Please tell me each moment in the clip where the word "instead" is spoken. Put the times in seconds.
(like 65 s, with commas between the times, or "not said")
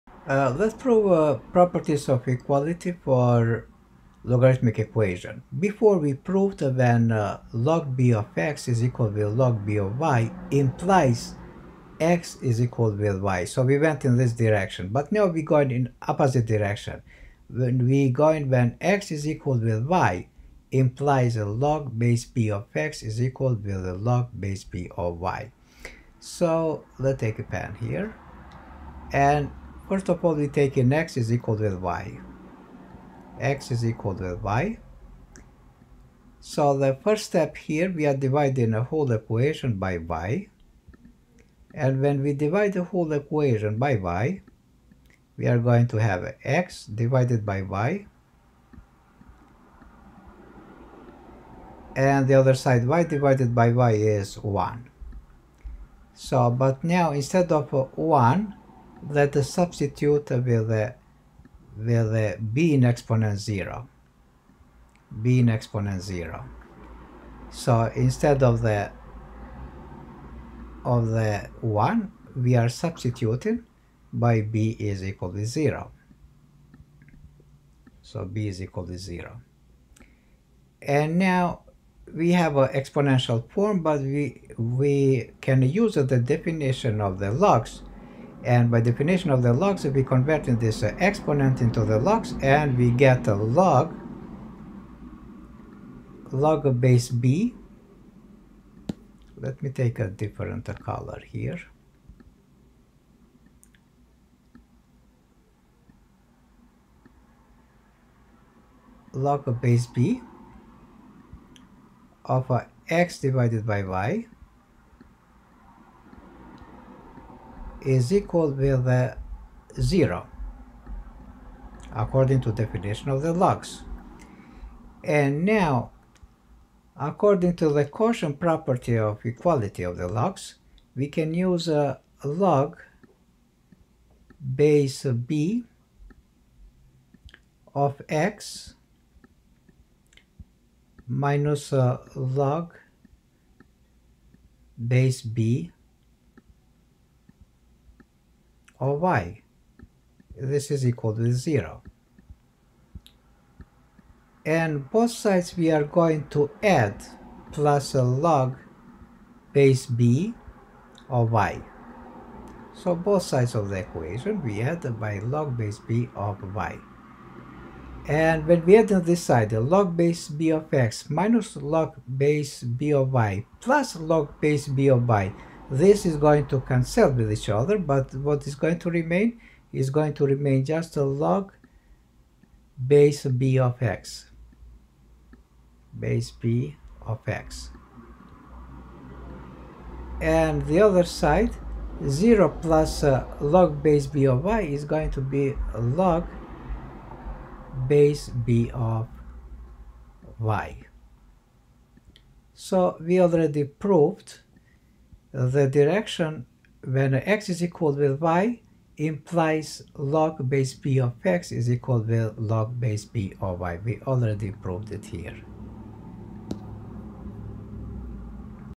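57 s, 67 s.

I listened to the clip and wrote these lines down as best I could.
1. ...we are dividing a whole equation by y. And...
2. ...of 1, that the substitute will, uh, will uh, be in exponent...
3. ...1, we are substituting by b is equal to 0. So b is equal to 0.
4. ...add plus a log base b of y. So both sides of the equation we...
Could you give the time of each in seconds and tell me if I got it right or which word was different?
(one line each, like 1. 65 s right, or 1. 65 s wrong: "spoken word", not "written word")
1. 37 s right
2. 57 s right
3. 71 s right
4. 156 s right.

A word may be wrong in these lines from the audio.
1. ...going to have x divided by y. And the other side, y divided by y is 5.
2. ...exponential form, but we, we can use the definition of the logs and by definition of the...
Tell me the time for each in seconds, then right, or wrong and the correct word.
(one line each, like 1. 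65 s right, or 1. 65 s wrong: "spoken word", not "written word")
1. 45 s wrong: "1", not "5"
2. 82 s right.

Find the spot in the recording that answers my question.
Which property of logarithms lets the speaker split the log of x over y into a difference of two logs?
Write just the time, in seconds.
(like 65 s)
127 s.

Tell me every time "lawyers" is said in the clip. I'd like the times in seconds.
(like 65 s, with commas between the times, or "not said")
not said.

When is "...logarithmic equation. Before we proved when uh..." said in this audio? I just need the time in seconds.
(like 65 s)
4 s.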